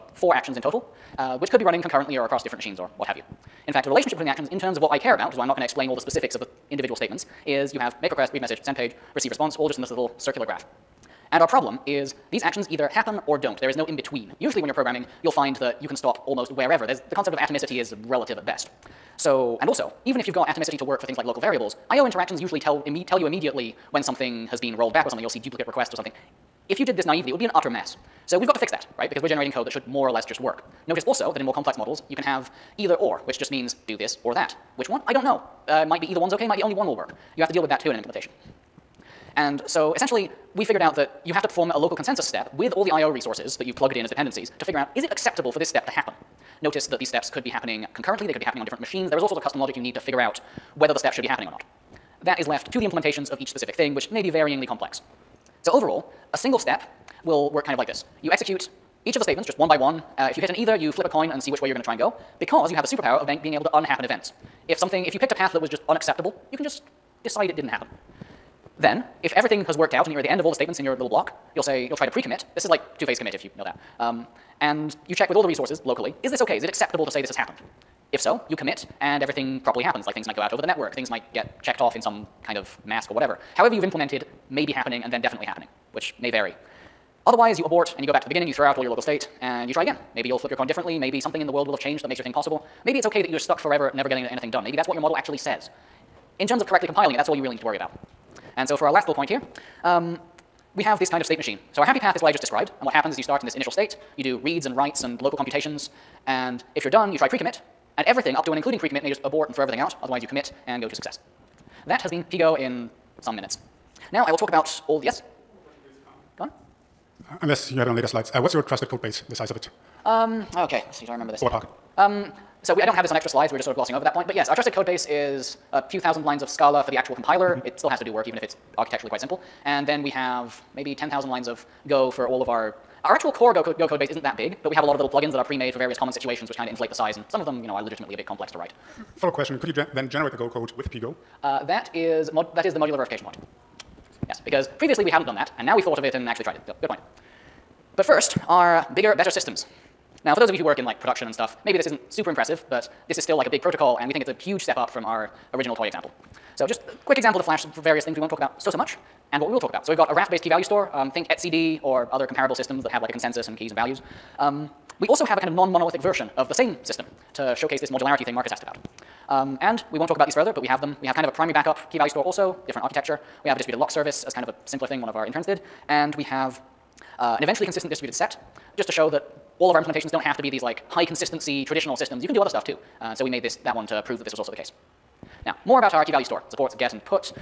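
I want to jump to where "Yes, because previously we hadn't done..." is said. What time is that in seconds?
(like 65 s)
144 s.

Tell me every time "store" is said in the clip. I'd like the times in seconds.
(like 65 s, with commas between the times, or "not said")
160 s, 172 s, 186 s.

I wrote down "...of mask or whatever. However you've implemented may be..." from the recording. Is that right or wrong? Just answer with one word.
right.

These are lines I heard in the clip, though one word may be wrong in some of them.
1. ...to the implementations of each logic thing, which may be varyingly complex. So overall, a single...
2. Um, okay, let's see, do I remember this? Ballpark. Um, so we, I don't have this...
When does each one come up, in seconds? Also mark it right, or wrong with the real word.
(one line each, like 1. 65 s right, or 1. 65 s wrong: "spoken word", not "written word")
1. 52 s wrong: "specific", not "logic"
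2. 120 s right.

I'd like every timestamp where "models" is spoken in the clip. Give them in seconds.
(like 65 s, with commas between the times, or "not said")
31 s, 94 s.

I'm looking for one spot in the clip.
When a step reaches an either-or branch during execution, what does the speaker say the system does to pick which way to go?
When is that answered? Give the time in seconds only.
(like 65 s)
60 s.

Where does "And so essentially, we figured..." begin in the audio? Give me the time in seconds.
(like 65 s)
39 s.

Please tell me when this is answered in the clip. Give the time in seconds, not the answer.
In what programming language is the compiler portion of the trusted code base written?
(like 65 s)
126 s.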